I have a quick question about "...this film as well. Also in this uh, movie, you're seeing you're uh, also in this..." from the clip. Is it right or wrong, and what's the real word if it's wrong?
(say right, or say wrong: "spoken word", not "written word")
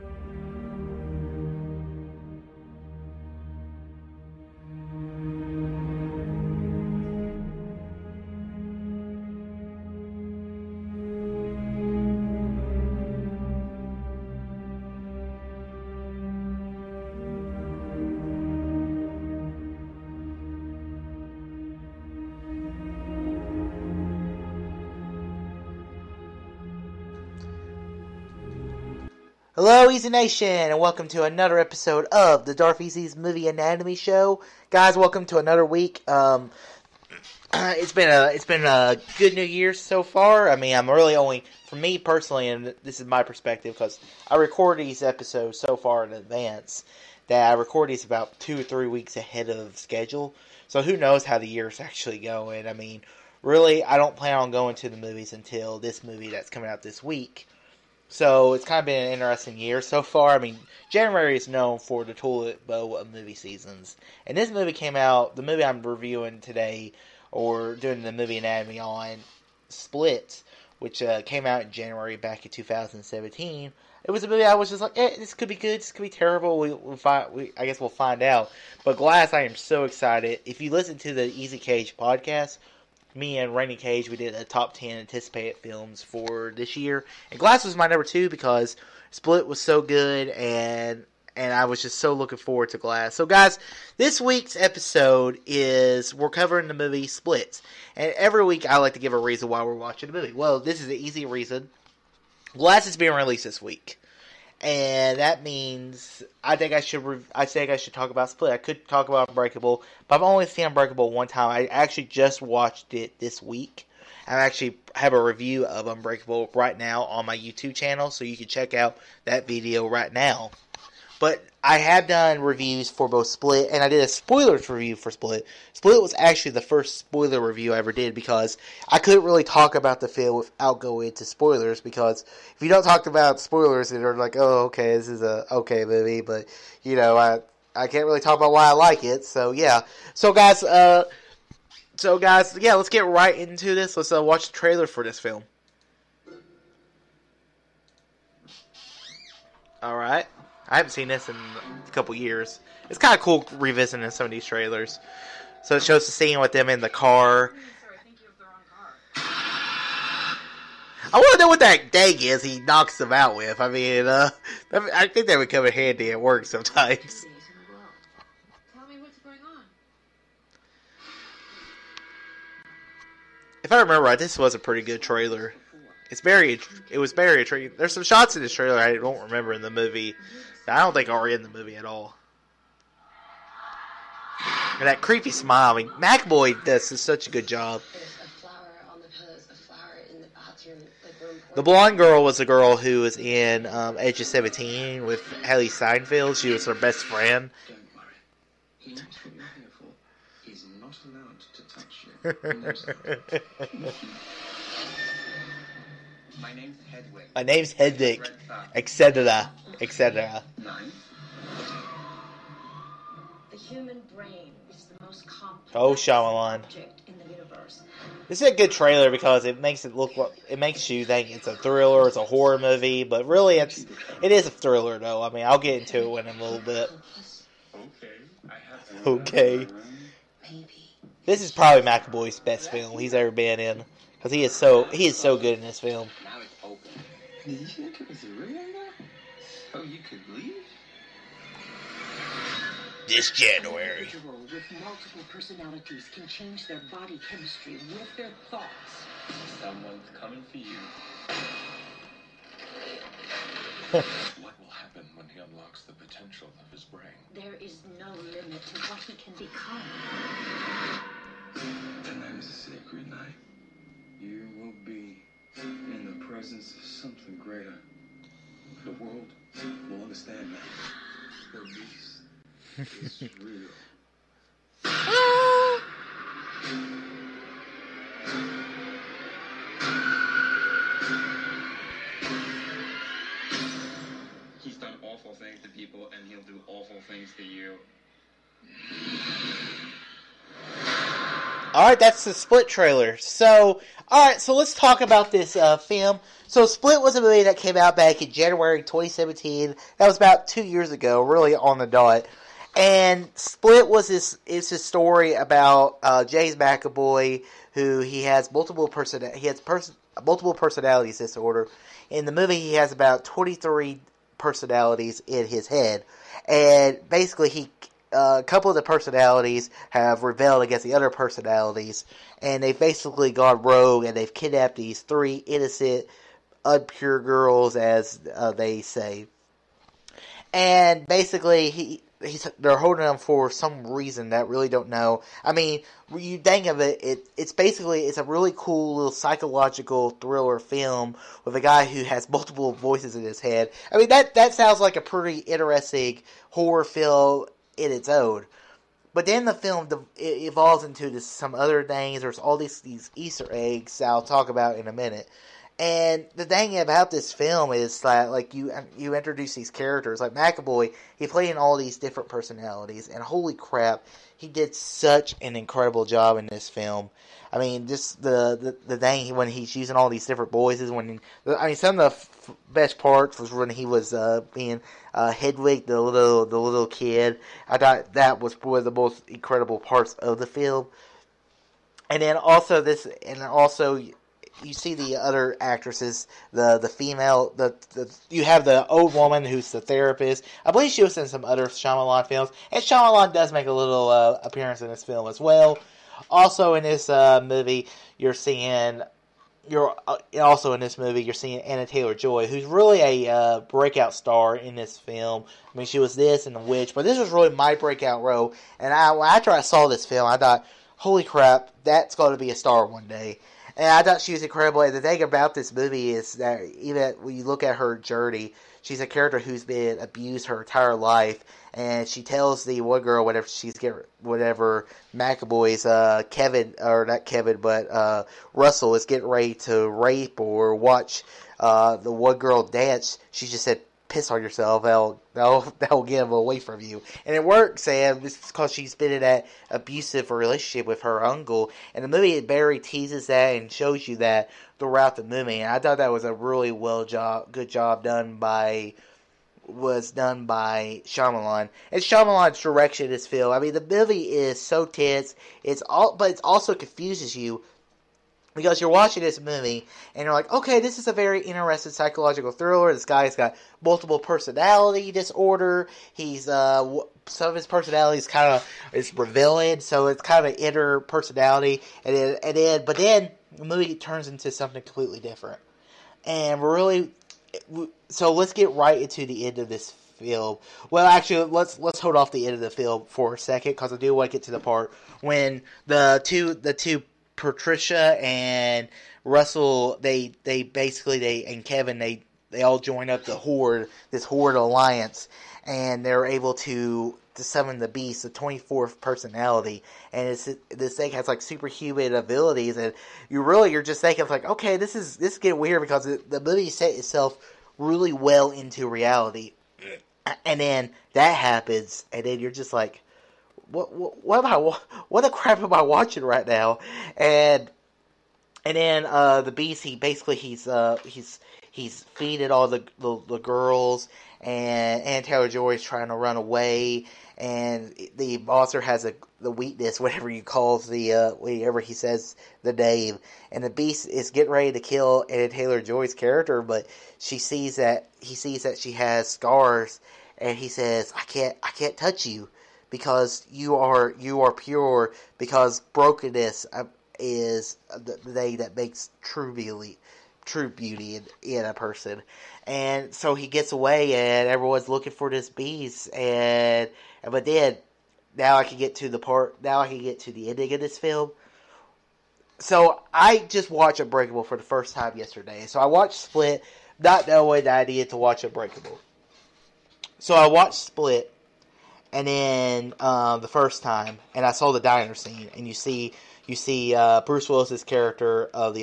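right.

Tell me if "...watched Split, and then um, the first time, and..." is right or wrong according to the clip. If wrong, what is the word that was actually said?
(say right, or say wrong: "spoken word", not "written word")
right.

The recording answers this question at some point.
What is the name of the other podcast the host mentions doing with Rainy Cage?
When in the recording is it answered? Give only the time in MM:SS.
01:21.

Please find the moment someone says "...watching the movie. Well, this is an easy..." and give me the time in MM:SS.
01:39.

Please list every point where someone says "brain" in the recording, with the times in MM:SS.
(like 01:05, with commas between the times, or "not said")
03:34, 04:16.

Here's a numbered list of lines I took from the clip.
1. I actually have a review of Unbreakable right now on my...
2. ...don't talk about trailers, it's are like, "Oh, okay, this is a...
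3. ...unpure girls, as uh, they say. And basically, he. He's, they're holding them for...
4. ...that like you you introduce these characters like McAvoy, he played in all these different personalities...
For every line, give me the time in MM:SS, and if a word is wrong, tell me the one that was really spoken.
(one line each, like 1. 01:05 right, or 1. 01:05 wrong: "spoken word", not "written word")
1. 01:54 right
2. 02:12 wrong: "spoilers", not "trailers"
3. 05:26 right
4. 05:58 right.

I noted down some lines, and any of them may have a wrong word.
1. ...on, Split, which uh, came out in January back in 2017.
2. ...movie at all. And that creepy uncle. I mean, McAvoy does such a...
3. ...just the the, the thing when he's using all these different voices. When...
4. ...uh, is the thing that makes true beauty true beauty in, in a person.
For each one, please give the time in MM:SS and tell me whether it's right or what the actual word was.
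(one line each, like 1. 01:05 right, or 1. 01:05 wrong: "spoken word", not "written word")
1. 01:08 right
2. 03:01 wrong: "smile", not "uncle"
3. 06:07 right
4. 09:06 right.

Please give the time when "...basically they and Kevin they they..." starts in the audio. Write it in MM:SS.
08:10.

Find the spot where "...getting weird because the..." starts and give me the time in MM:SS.
08:25.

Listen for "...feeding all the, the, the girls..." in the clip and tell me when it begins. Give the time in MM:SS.
08:42.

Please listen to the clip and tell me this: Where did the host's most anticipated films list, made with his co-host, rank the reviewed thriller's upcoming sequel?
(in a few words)
number two.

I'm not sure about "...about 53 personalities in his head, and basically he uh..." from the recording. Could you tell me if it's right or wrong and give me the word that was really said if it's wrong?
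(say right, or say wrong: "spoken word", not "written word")
wrong: "23", not "53".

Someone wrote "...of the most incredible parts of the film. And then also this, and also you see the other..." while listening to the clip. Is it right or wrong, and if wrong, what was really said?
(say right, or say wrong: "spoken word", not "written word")
right.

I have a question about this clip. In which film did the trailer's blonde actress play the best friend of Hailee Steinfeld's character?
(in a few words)
Edge of 17.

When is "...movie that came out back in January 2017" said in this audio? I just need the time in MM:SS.
04:57.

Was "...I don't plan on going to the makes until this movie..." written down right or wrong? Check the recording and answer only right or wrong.
wrong.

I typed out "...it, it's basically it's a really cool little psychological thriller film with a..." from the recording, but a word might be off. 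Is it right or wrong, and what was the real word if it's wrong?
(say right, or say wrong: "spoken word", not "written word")
right.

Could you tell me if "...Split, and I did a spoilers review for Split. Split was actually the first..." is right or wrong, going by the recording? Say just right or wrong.
right.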